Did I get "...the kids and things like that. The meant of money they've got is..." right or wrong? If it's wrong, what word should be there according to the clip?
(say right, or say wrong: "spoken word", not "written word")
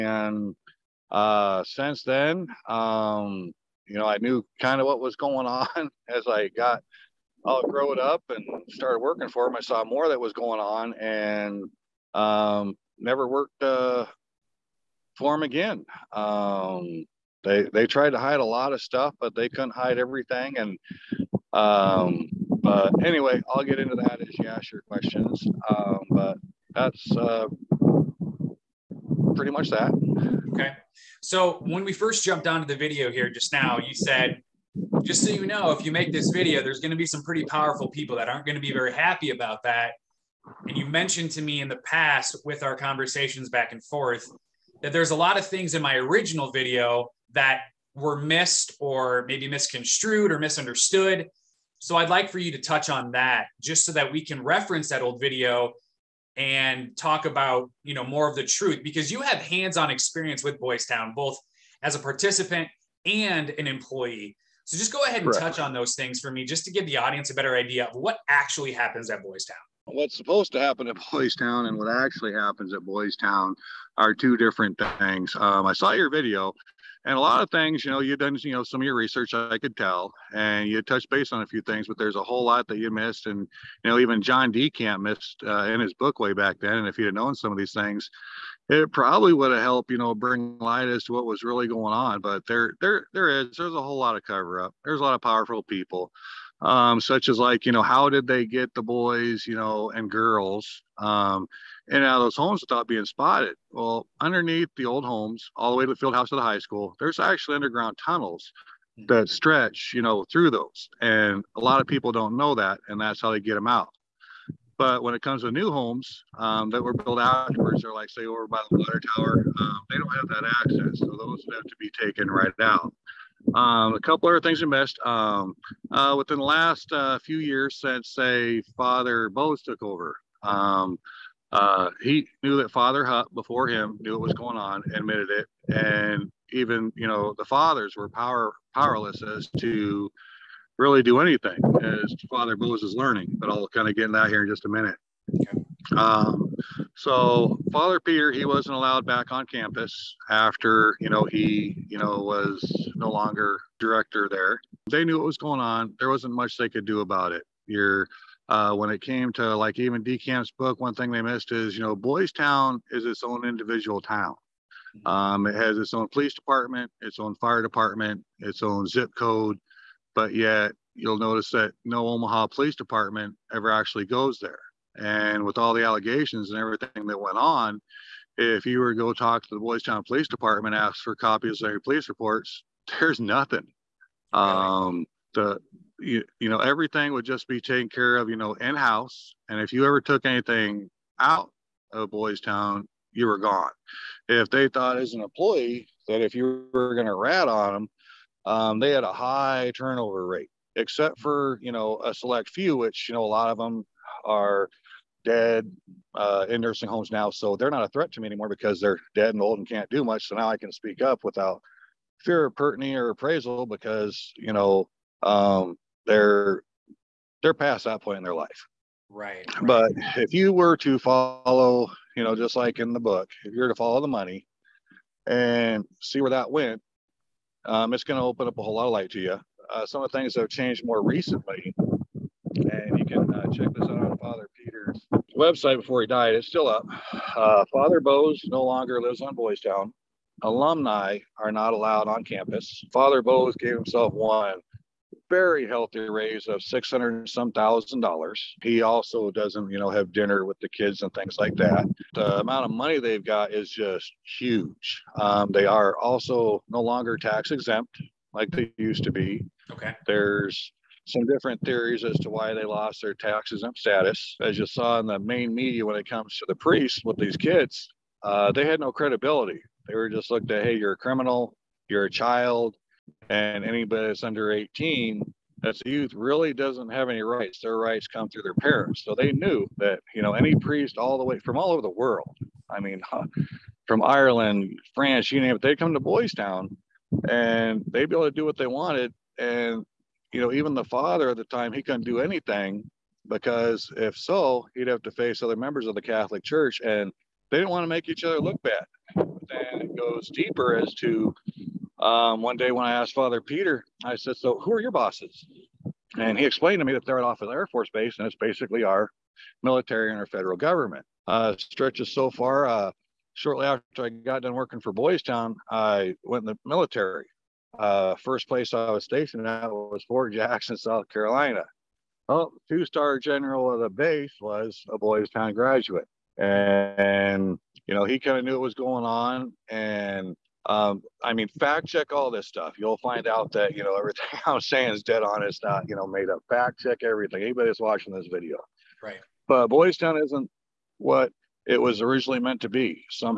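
wrong: "amount", not "meant".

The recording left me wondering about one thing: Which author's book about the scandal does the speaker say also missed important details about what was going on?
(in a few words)
John DeCamp.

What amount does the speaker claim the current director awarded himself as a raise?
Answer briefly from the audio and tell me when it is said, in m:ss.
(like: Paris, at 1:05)
Six hundred some thousand dollars, at 4:06.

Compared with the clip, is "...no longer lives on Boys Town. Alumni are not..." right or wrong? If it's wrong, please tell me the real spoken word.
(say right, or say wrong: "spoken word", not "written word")
right.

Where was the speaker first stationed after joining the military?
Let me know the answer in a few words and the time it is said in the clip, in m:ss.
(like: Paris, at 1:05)
Fort Jackson, South Carolina, at 5:20.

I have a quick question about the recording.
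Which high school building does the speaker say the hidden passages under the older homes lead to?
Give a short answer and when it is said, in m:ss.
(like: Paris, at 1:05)
The field house, at 1:45.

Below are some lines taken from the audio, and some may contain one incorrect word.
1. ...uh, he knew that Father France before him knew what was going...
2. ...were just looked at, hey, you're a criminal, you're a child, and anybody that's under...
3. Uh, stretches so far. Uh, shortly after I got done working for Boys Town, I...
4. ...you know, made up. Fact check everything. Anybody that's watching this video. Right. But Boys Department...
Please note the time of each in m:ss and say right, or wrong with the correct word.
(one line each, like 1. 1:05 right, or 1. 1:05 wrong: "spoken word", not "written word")
1. 2:11 wrong: "Hupp", not "France"
2. 4:29 right
3. 5:11 right
4. 5:35 wrong: "Town", not "Department".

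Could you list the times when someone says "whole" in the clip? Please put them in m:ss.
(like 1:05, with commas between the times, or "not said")
1:22, 1:33, 3:48.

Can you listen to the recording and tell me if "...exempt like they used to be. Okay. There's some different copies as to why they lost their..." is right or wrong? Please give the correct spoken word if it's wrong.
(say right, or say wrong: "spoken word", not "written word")
wrong: "theories", not "copies".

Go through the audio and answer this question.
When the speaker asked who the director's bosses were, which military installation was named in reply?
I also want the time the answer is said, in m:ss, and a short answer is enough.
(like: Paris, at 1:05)
Offutt Air Force Base, at 5:07.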